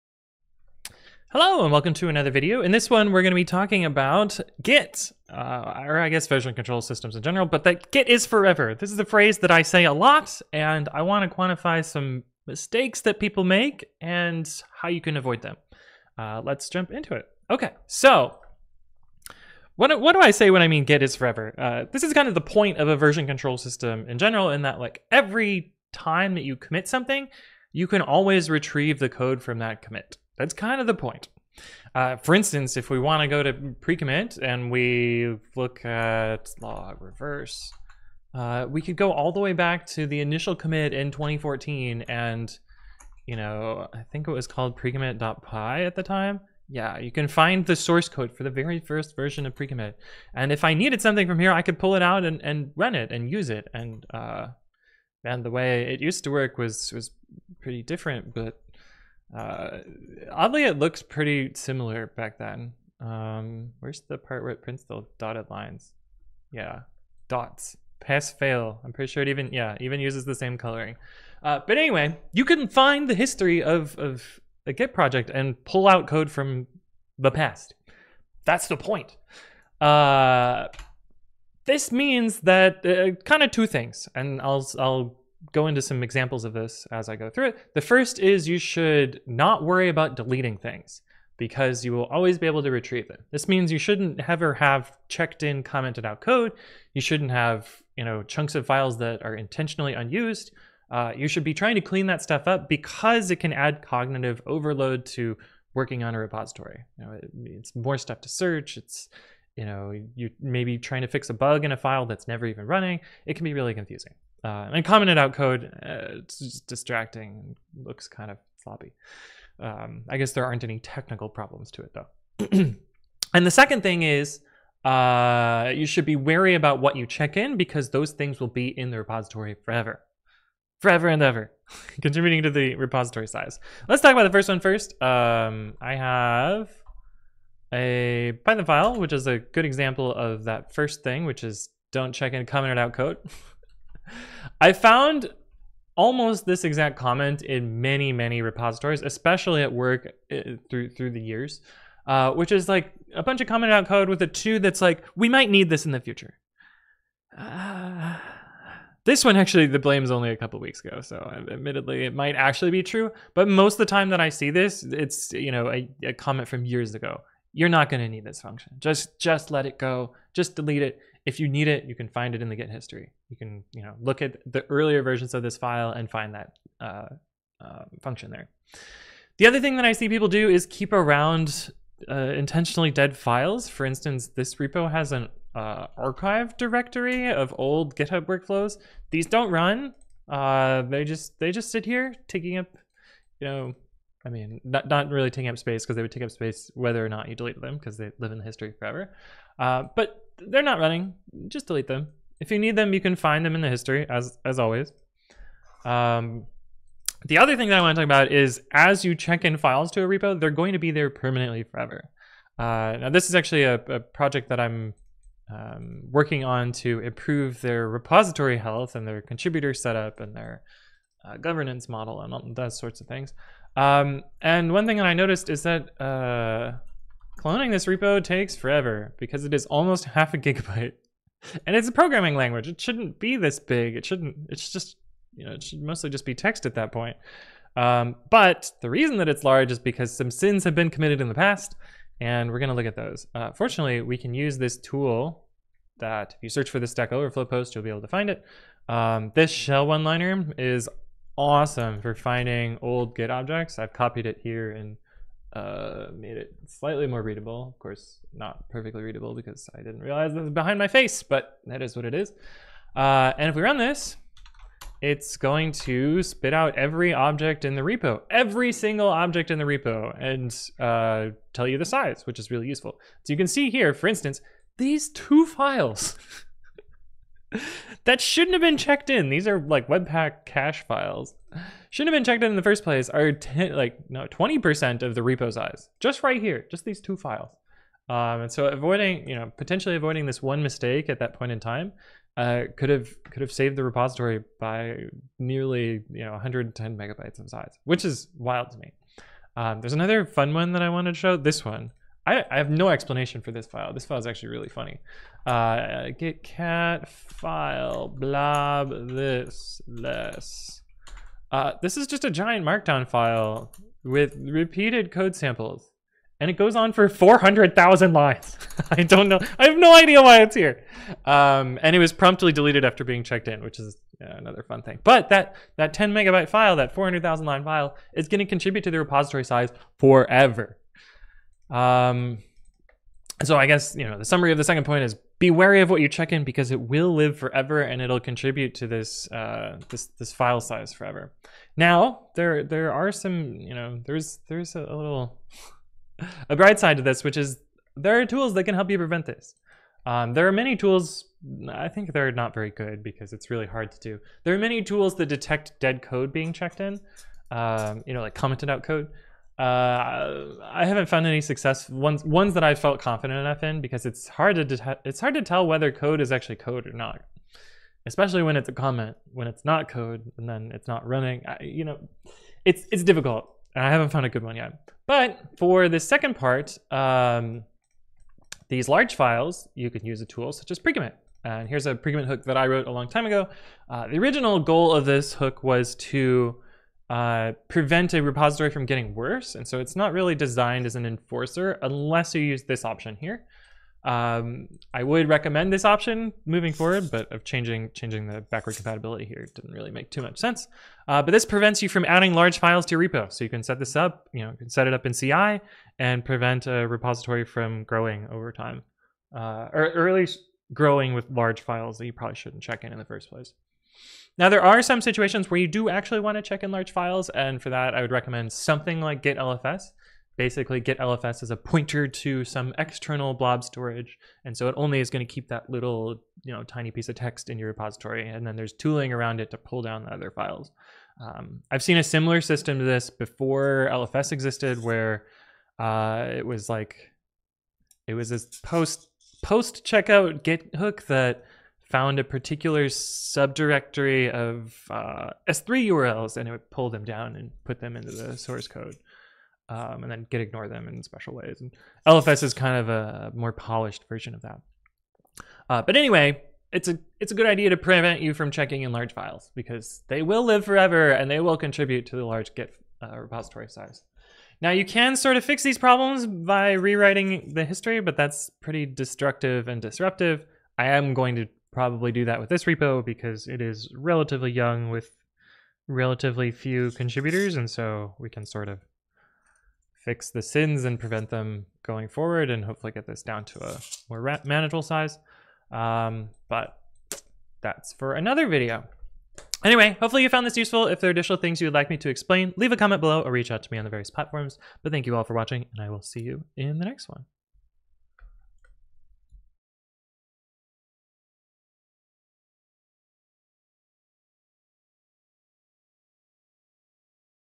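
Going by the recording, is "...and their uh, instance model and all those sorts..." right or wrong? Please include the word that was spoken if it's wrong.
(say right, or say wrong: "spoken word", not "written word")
wrong: "governance", not "instance".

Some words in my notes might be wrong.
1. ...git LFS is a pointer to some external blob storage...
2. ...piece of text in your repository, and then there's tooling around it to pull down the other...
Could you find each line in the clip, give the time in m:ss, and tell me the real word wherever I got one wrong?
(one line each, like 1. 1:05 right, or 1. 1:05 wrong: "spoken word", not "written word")
1. 7:00 right
2. 7:06 right.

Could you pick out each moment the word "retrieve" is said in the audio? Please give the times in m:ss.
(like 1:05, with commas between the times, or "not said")
0:28, 1:32.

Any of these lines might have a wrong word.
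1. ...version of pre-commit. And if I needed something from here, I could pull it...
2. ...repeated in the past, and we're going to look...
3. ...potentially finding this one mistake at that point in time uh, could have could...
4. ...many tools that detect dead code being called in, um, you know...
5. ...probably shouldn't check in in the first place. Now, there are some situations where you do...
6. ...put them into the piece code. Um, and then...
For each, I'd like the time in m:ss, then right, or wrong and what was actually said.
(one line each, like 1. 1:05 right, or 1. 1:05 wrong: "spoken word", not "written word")
1. 0:49 right
2. 4:00 wrong: "committed", not "repeated"
3. 4:49 wrong: "avoiding", not "finding"
4. 5:54 wrong: "checked", not "called"
5. 6:52 right
6. 7:27 wrong: "source", not "piece".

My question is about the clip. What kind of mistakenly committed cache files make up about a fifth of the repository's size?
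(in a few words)
Webpack cache files.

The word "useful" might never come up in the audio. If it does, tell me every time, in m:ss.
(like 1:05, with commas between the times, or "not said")
4:32, 8:10.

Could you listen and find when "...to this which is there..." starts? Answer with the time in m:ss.
5:46.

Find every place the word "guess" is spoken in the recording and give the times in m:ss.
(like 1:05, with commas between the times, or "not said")
0:06, 2:00, 5:33.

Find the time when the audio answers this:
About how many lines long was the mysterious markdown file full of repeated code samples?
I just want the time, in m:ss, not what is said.
5:17.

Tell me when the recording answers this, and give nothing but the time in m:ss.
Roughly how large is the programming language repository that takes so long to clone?
3:50.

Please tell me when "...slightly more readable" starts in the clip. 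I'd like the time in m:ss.
4:16.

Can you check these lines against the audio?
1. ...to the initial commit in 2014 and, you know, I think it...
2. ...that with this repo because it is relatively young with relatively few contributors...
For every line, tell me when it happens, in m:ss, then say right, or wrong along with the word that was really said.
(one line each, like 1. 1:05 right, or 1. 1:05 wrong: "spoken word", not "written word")
1. 0:39 right
2. 7:52 right.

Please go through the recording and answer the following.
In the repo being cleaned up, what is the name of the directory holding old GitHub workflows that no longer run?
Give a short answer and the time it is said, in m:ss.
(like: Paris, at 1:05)
archive, at 3:05.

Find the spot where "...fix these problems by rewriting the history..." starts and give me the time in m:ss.
7:45.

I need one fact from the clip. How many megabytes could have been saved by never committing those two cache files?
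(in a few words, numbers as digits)
110.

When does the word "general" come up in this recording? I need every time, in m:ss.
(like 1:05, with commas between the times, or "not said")
0:07, 0:24.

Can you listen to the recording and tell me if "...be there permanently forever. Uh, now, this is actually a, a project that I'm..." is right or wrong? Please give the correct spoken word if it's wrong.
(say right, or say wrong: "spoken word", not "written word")
right.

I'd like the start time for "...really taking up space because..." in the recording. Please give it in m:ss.
3:15.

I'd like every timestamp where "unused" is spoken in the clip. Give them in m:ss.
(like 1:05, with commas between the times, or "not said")
1:39.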